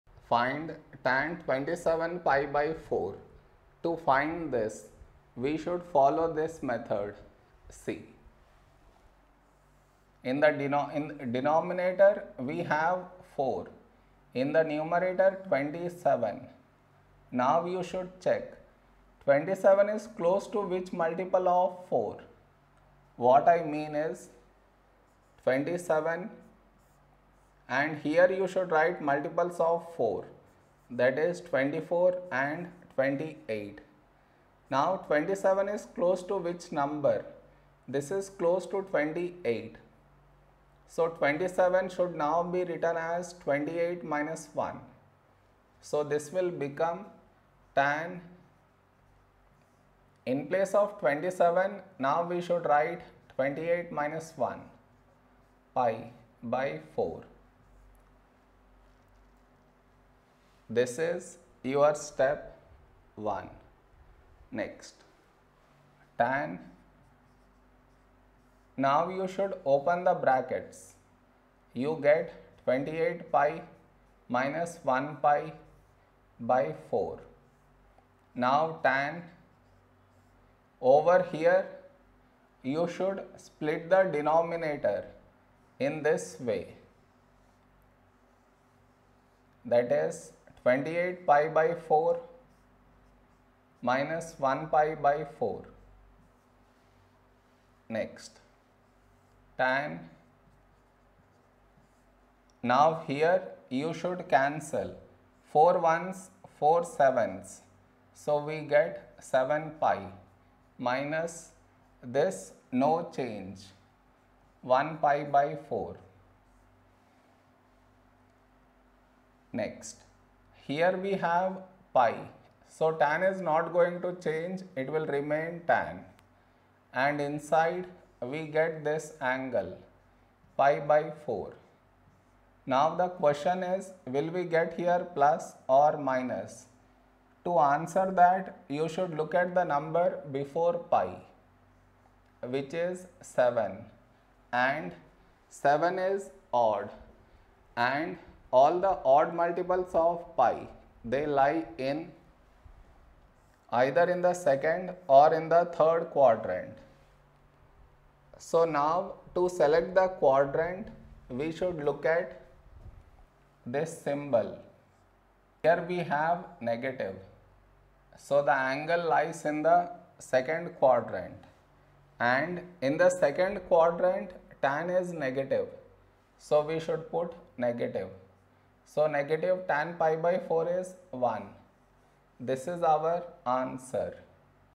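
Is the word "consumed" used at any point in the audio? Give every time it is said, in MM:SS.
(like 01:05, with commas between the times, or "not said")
not said.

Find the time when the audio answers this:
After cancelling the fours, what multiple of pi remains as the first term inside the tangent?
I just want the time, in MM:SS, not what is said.
01:49.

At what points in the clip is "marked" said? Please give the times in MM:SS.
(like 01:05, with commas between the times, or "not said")
not said.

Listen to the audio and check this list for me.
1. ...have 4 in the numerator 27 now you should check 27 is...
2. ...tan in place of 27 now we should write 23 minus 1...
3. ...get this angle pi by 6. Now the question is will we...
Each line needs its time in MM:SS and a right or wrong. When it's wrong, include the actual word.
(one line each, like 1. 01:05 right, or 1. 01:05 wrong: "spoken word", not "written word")
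1. 00:12 right
2. 00:47 wrong: "28", not "23"
3. 02:08 wrong: "4", not "6".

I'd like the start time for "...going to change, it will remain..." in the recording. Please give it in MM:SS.
02:03.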